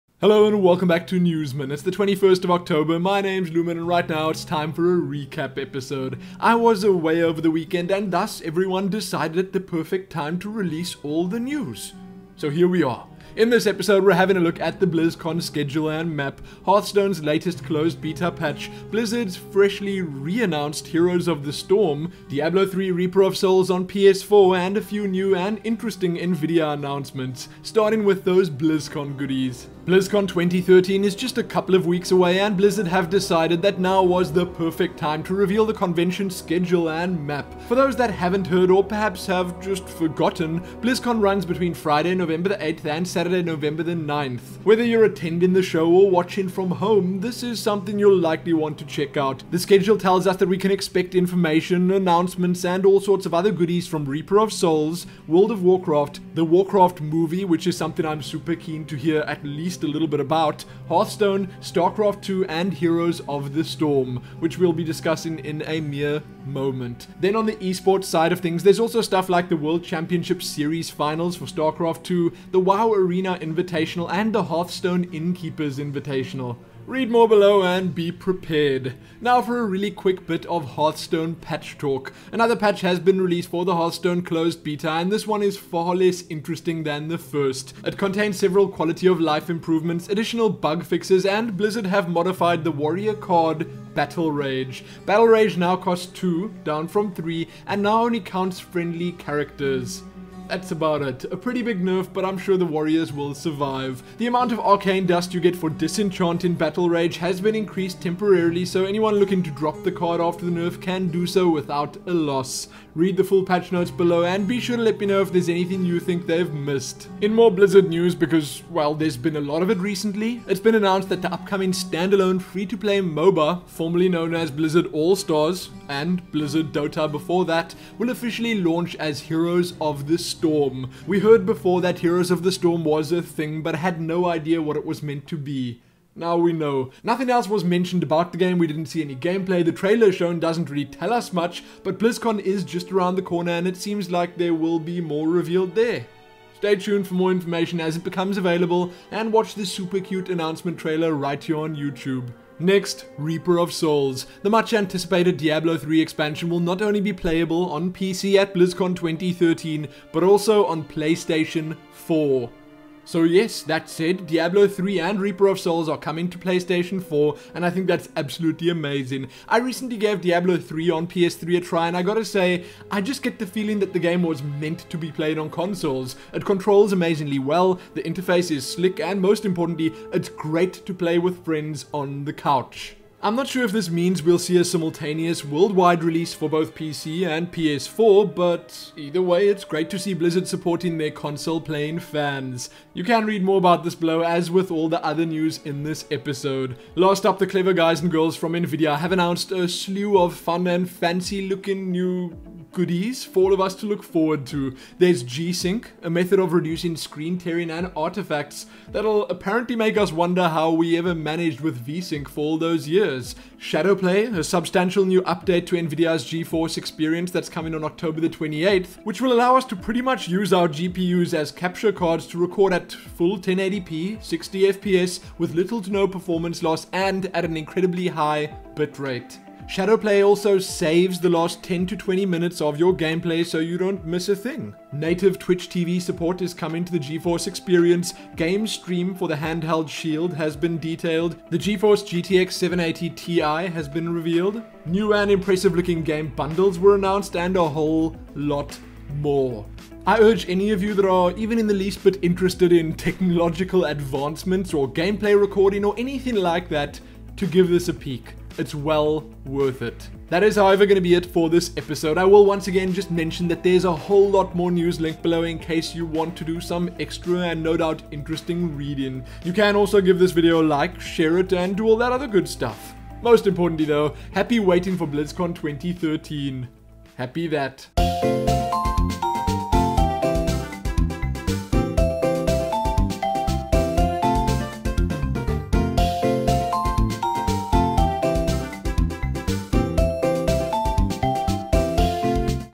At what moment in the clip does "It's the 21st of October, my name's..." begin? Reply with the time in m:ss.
0:01.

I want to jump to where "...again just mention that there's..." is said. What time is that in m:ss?
4:22.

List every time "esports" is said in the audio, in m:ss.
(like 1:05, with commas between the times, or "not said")
1:07.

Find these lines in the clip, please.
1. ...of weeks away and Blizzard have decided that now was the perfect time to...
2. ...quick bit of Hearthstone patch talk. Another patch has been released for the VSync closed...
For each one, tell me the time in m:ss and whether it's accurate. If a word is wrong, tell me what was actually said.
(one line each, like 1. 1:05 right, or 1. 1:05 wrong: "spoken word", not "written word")
1. 0:31 right
2. 1:19 wrong: "Hearthstone", not "VSync".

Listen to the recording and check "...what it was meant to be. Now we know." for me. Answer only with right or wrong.
right.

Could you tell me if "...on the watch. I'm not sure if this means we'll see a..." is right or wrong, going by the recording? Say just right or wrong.
wrong.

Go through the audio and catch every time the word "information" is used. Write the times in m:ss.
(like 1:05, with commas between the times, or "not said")
0:51, 2:27.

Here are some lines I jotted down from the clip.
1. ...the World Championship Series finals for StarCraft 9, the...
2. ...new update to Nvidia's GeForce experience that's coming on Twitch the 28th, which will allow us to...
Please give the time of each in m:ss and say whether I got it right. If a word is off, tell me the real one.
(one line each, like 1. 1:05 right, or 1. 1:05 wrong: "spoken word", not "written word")
1. 1:09 wrong: "2", not "9"
2. 3:35 wrong: "October", not "Twitch".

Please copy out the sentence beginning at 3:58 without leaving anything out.
Game stream for the handheld Shield has been detailed.